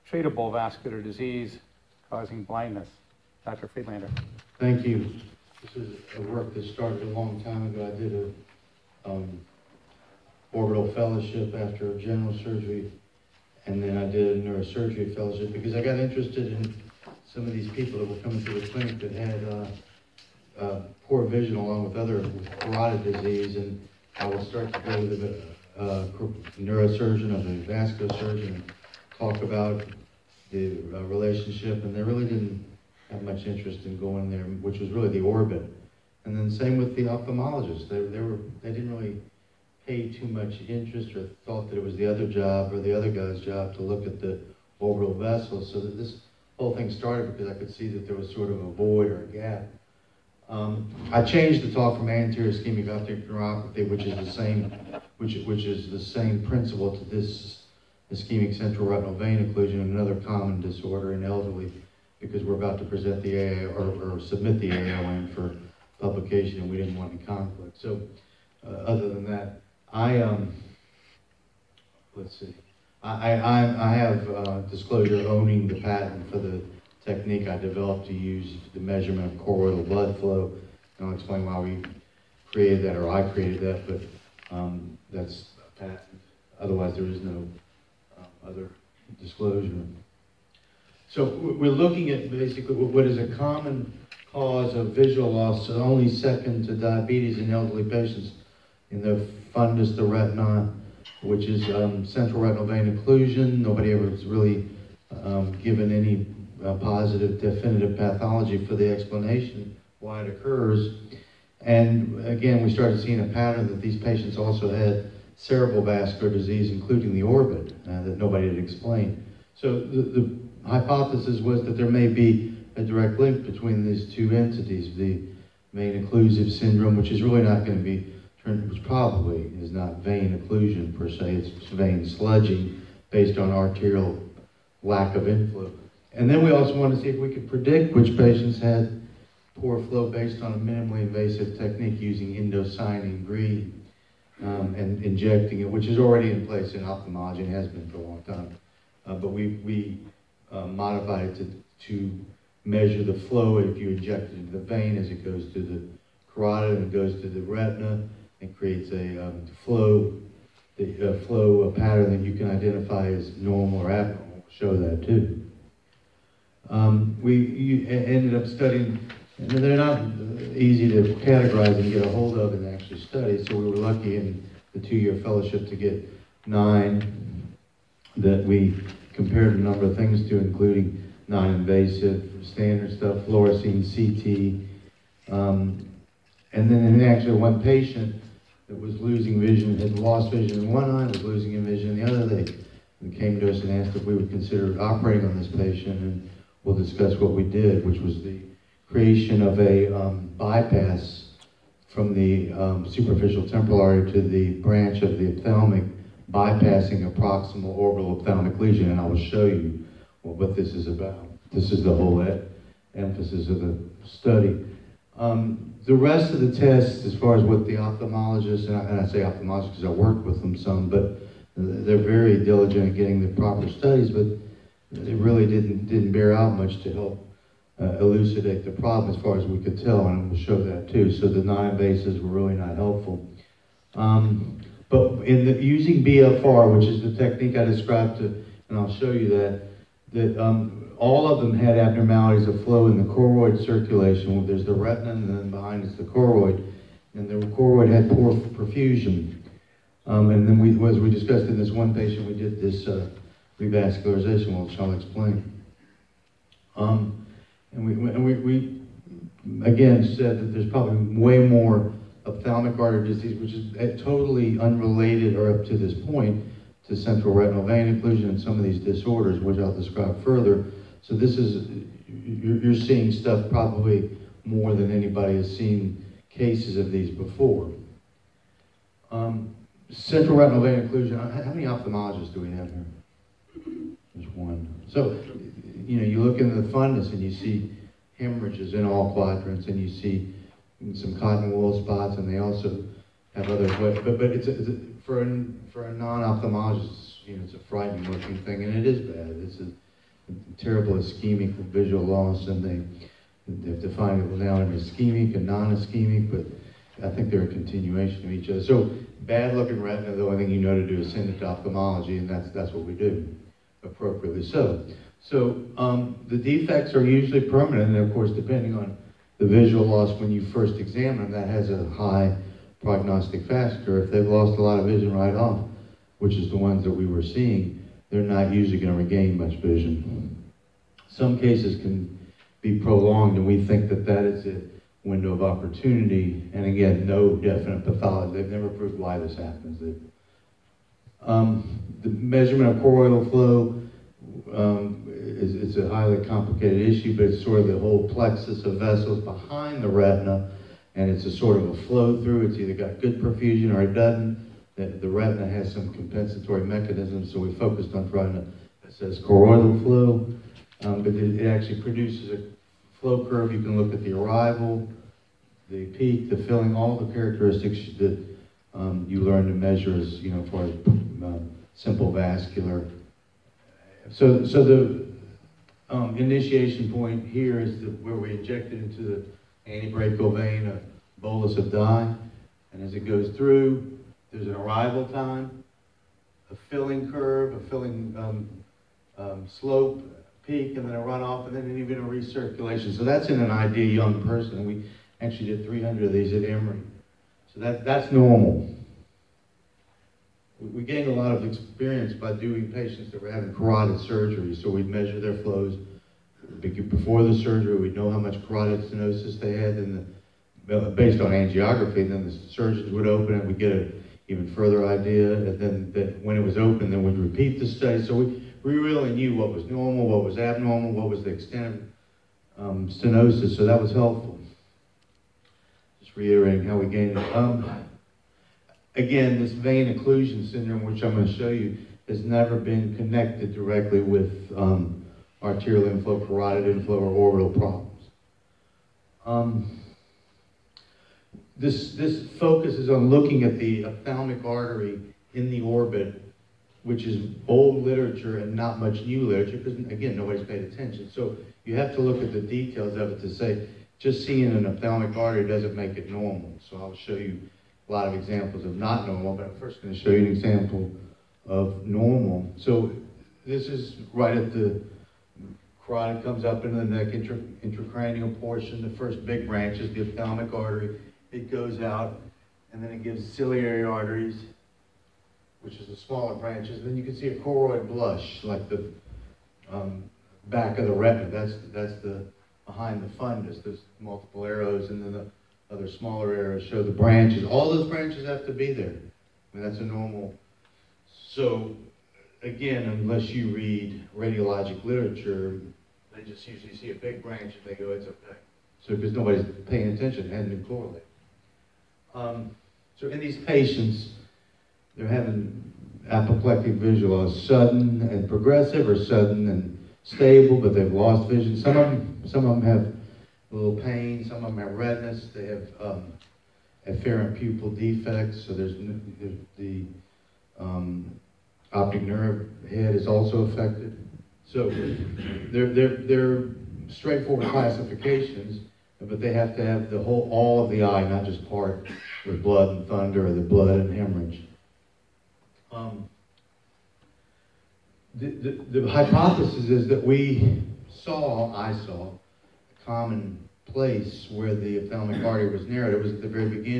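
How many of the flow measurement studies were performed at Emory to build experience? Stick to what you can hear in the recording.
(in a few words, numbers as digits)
300.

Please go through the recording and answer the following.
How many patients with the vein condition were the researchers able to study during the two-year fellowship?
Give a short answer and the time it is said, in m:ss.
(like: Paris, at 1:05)
9, at 2:56.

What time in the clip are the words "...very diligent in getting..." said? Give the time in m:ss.
3:41.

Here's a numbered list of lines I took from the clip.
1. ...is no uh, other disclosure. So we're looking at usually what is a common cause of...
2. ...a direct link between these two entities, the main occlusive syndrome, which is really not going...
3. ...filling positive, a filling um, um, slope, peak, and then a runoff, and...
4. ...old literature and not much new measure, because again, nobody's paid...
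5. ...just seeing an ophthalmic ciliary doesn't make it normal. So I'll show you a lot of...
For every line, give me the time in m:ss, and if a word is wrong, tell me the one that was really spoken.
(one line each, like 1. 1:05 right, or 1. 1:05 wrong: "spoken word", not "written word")
1. 1:27 wrong: "basically", not "usually"
2. 2:02 right
3. 6:26 wrong: "curve", not "positive"
4. 7:27 wrong: "literature", not "measure"
5. 7:33 wrong: "artery", not "ciliary".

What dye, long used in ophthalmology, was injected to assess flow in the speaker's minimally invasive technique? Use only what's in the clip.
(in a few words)
indocyanine green.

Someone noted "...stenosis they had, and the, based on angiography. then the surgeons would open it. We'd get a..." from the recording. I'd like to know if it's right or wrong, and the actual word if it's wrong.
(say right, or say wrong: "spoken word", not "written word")
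right.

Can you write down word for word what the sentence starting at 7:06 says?
Just reiterating how we gained it.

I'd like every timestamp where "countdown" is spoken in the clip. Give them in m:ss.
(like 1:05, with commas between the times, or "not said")
not said.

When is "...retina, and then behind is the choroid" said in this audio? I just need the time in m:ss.
4:04.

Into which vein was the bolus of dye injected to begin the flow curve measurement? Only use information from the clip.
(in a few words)
antebrachial vein.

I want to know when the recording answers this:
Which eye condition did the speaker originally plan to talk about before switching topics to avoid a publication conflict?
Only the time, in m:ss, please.
0:52.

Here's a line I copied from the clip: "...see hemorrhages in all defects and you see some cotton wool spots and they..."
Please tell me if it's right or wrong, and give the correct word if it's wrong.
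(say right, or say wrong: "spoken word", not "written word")
wrong: "quadrants", not "defects".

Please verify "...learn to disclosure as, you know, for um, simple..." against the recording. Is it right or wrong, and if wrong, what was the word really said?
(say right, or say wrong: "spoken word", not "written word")
wrong: "measure", not "disclosure".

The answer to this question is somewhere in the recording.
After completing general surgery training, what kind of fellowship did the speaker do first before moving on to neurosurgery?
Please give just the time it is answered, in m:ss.
0:10.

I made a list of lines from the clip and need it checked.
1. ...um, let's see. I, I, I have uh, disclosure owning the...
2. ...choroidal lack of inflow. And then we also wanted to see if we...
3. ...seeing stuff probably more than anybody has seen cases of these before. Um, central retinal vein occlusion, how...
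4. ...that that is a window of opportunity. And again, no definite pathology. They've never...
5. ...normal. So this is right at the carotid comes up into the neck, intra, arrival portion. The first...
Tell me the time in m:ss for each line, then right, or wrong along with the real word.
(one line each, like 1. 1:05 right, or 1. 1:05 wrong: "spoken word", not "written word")
1. 1:10 right
2. 2:13 wrong: "arterial", not "choroidal"
3. 4:32 right
4. 5:33 right
5. 7:41 wrong: "intracranial", not "arrival".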